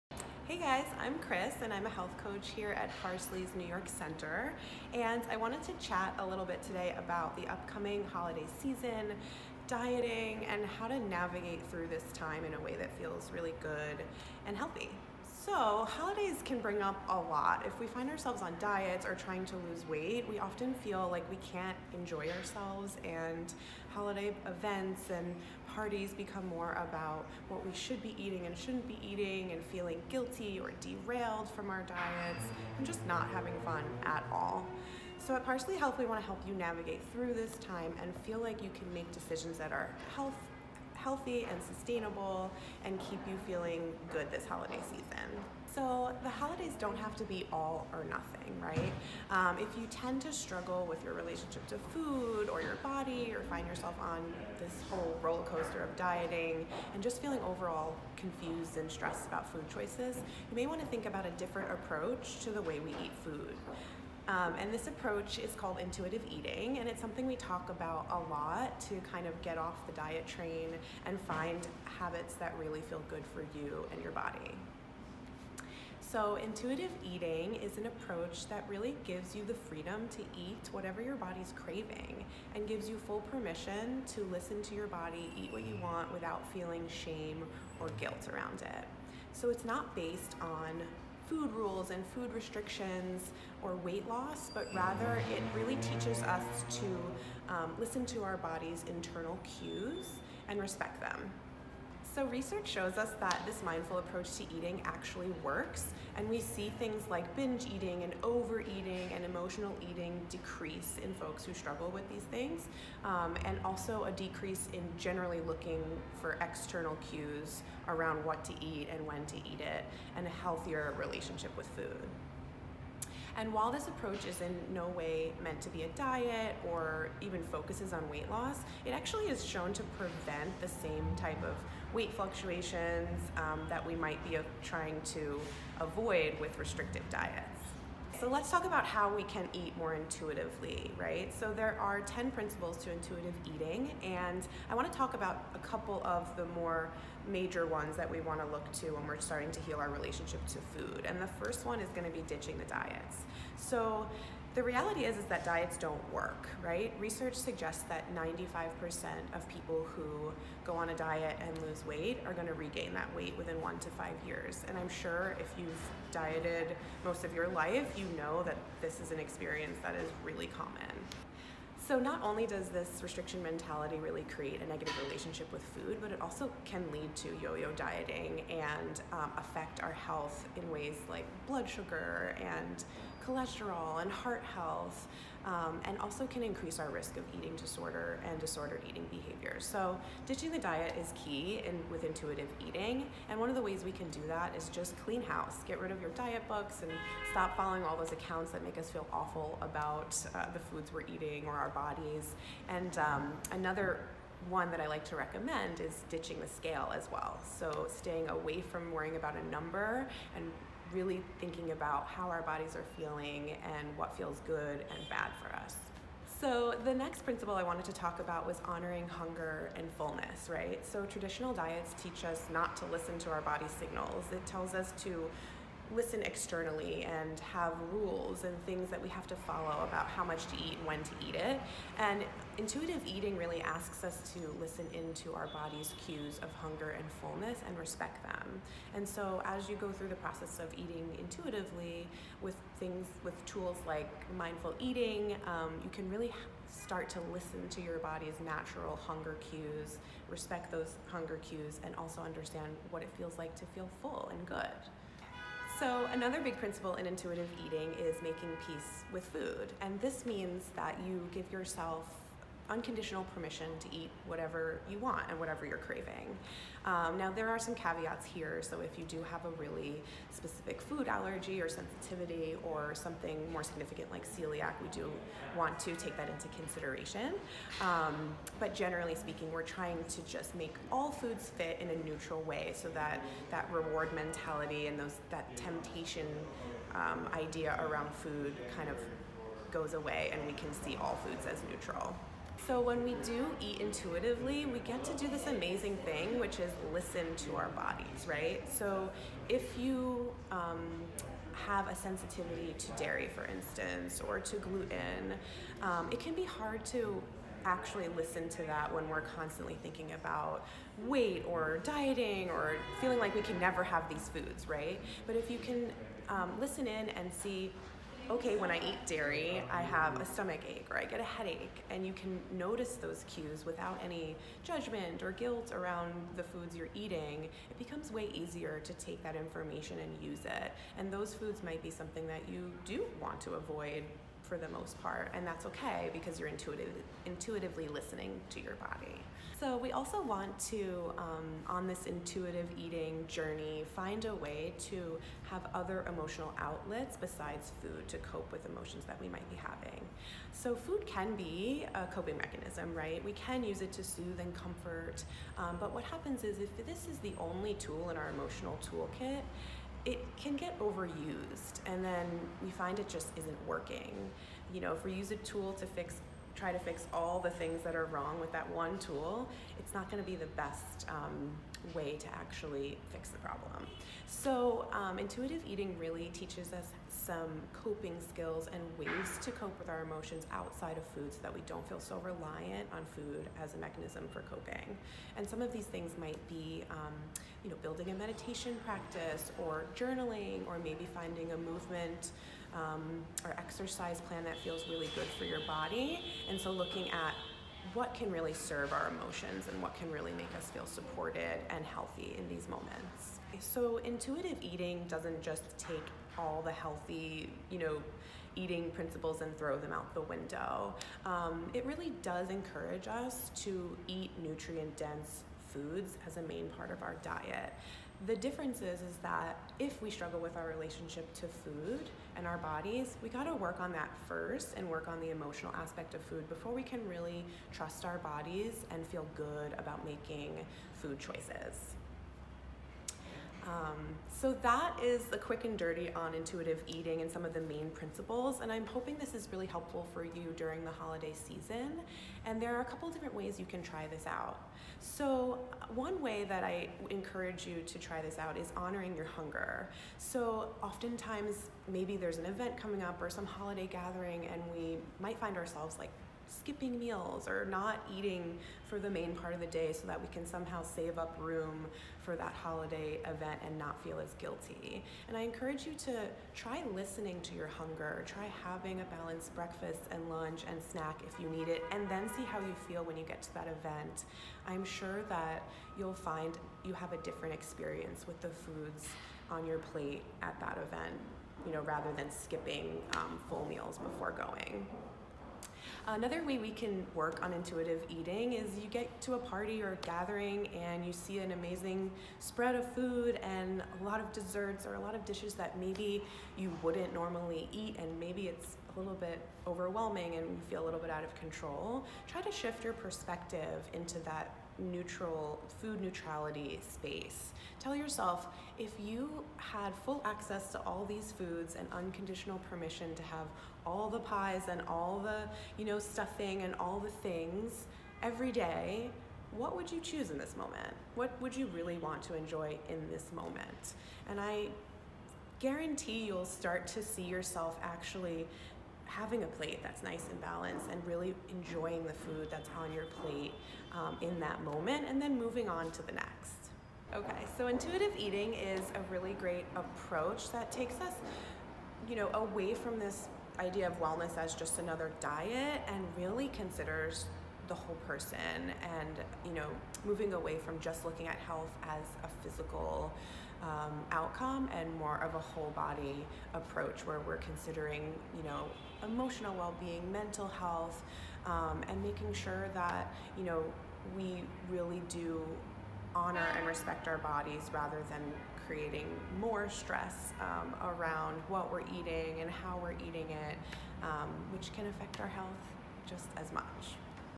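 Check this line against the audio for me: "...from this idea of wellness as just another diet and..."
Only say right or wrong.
right.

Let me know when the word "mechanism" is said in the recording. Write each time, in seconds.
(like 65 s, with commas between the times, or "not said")
352 s, 383 s.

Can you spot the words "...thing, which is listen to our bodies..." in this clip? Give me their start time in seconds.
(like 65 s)
296 s.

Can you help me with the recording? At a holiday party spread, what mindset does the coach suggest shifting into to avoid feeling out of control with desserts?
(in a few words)
food neutrality.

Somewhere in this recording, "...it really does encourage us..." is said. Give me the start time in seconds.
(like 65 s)
411 s.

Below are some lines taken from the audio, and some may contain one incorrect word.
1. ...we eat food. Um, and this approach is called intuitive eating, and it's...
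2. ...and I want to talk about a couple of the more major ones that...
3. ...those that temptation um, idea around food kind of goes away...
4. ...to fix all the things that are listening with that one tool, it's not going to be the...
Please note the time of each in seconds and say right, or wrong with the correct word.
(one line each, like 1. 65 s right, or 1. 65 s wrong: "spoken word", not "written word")
1. 62 s right
2. 144 s right
3. 284 s right
4. 366 s wrong: "wrong", not "listening".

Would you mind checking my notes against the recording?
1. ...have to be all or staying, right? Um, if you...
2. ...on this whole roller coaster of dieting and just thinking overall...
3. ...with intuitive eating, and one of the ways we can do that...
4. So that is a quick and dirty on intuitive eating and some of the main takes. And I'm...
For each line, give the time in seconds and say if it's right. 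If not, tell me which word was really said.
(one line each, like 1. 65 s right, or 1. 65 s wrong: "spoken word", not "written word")
1. 46 s wrong: "nothing", not "staying"
2. 54 s wrong: "feeling", not "thinking"
3. 191 s right
4. 434 s wrong: "principles", not "takes".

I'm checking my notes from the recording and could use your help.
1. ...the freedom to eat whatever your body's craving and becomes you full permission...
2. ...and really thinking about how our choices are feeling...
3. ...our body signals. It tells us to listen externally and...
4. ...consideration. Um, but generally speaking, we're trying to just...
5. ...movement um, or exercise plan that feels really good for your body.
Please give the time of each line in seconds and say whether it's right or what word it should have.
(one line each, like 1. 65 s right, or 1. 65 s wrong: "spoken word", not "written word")
1. 79 s wrong: "gives", not "becomes"
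2. 210 s wrong: "bodies", not "choices"
3. 223 s right
4. 276 s right
5. 391 s right.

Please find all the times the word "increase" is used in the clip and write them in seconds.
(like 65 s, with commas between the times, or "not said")
186 s.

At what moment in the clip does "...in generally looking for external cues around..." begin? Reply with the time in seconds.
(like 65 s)
114 s.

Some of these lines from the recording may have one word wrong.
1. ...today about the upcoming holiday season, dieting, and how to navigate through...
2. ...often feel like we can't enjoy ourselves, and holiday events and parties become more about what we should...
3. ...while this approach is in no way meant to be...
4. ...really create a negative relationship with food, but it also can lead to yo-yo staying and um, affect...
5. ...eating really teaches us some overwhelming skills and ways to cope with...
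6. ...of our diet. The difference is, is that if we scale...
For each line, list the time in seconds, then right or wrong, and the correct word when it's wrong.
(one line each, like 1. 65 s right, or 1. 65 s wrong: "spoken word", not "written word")
1. 6 s right
2. 20 s right
3. 123 s right
4. 173 s wrong: "dieting", not "staying"
5. 375 s wrong: "coping", not "overwhelming"
6. 416 s wrong: "struggle", not "scale".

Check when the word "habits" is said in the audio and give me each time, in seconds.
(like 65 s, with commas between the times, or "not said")
71 s.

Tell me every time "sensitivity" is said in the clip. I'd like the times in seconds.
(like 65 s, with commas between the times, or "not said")
271 s, 301 s.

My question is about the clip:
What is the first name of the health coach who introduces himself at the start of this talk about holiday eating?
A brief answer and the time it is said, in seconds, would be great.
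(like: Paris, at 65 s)
Chris, at 1 s.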